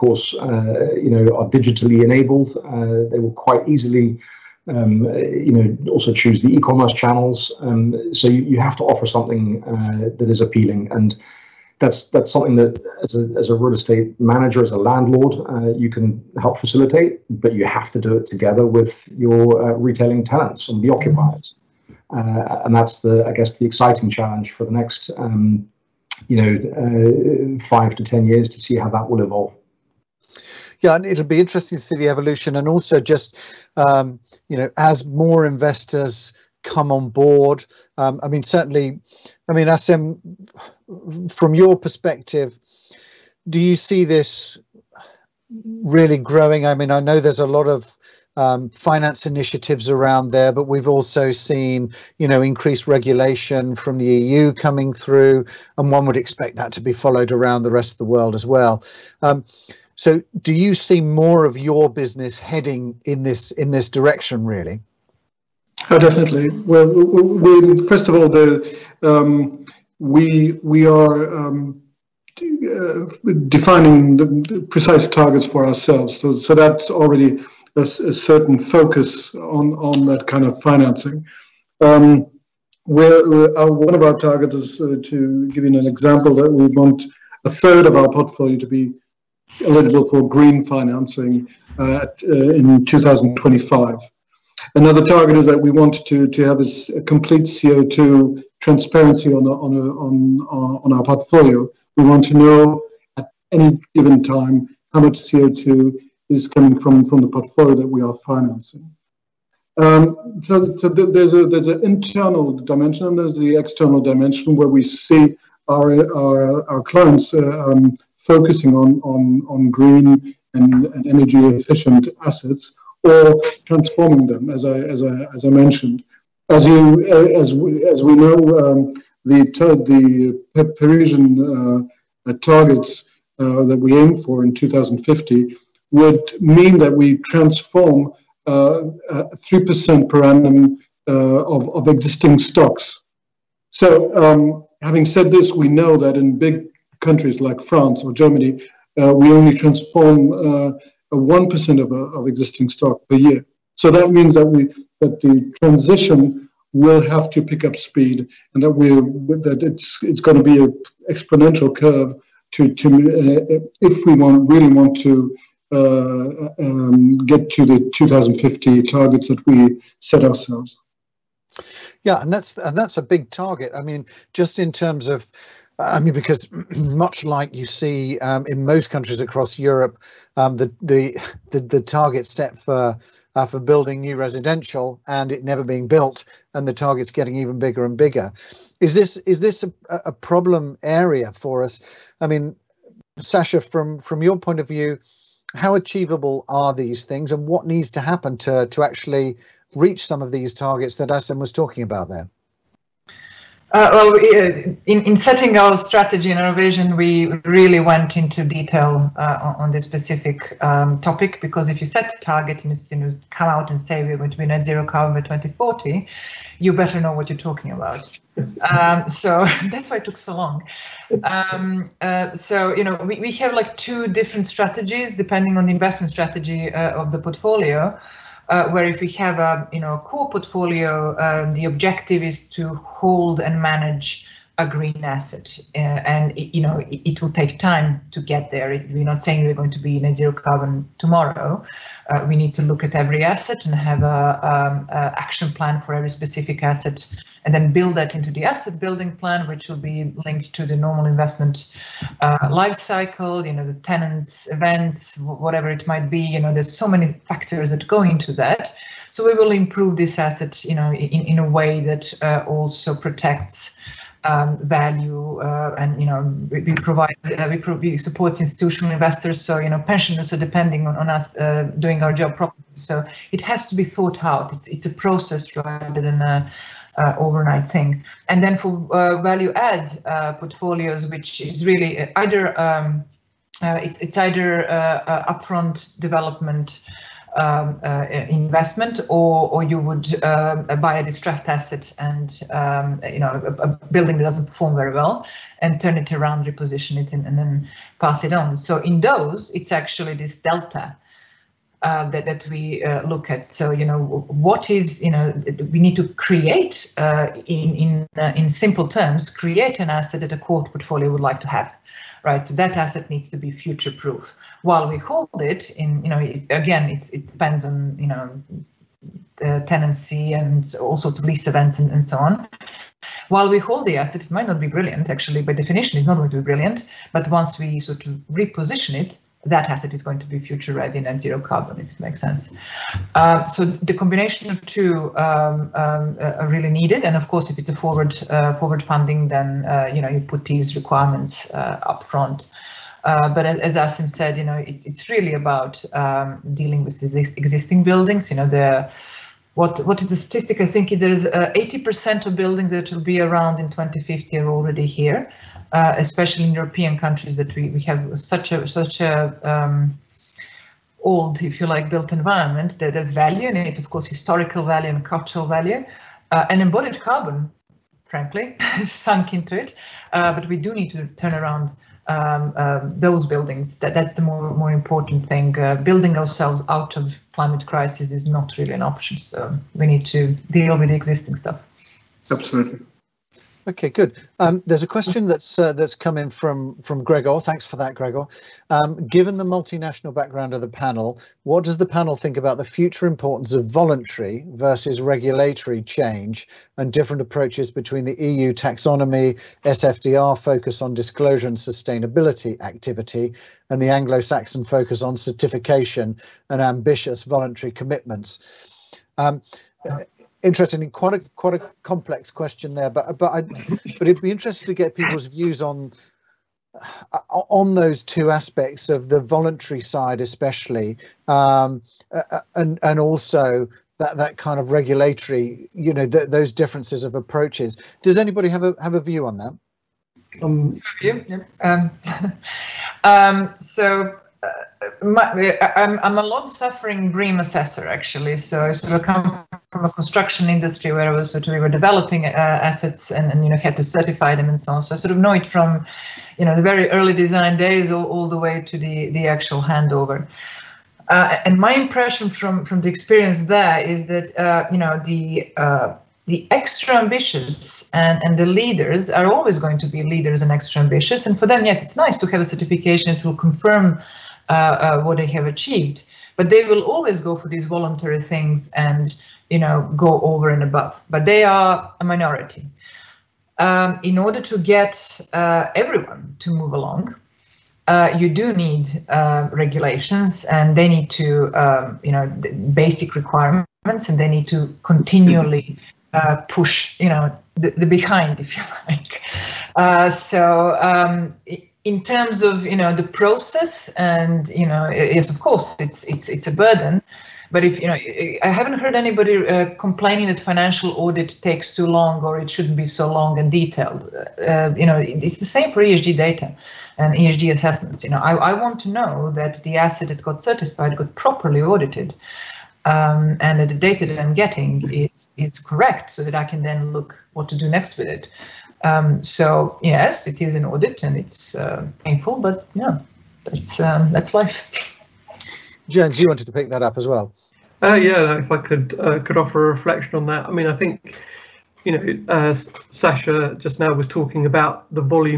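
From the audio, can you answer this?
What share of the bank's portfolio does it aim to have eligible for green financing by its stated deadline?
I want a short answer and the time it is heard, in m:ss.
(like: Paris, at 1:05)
a third, at 1:27.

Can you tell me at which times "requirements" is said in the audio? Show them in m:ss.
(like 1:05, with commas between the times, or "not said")
5:40, 8:03.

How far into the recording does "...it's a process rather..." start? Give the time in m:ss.
4:34.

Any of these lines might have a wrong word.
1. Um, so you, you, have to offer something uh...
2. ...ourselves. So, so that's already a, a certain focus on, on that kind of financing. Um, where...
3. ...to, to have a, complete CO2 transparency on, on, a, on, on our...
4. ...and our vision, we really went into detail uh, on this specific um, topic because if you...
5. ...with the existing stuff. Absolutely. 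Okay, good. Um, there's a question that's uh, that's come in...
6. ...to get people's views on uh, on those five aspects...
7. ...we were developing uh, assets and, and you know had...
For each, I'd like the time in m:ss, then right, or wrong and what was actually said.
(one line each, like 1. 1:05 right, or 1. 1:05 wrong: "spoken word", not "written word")
1. 0:07 right
2. 1:15 right
3. 1:36 right
4. 3:26 right
5. 6:20 right
6. 6:54 wrong: "two", not "five"
7. 7:21 right.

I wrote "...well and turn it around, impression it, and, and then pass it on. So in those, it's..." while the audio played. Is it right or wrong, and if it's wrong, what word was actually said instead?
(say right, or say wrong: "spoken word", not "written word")
wrong: "reposition", not "impression".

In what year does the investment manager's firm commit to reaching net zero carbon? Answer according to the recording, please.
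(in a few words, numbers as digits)
2040.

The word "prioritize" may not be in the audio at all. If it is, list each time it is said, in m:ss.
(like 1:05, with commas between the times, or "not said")
not said.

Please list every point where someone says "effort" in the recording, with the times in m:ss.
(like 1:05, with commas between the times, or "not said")
not said.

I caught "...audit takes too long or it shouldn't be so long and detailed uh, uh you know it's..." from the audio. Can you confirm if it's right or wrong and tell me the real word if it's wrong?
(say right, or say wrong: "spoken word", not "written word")
right.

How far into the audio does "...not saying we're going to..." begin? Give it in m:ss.
3:59.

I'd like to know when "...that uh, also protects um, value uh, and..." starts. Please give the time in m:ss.
4:21.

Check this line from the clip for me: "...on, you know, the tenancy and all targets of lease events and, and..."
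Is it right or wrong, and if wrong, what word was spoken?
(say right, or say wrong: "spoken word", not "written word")
wrong: "sorts", not "targets".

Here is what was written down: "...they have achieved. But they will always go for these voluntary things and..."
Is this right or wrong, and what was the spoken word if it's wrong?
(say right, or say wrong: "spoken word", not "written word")
right.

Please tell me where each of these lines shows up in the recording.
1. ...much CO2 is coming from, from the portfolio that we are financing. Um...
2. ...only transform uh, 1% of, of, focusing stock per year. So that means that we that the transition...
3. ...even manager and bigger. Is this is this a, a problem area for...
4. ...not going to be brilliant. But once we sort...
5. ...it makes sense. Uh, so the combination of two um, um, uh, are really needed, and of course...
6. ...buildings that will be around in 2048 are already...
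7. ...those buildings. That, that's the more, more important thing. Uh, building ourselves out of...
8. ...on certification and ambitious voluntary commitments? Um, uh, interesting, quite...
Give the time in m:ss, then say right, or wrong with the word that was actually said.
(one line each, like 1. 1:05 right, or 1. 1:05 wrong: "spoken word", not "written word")
1. 1:45 right
2. 2:29 wrong: "existing", not "focusing"
3. 3:07 wrong: "bigger", not "manager"
4. 5:26 right
5. 5:31 right
6. 5:52 wrong: "2050", not "2048"
7. 6:12 right
8. 6:45 right.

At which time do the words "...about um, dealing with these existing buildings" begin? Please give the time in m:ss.
5:45.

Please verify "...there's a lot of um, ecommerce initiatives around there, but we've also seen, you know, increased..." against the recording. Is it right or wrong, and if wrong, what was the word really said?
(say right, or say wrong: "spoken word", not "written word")
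wrong: "finance", not "ecommerce".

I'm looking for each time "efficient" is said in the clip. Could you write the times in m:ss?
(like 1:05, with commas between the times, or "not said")
2:01.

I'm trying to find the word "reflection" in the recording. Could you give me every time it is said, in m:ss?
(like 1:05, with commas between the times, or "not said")
8:49.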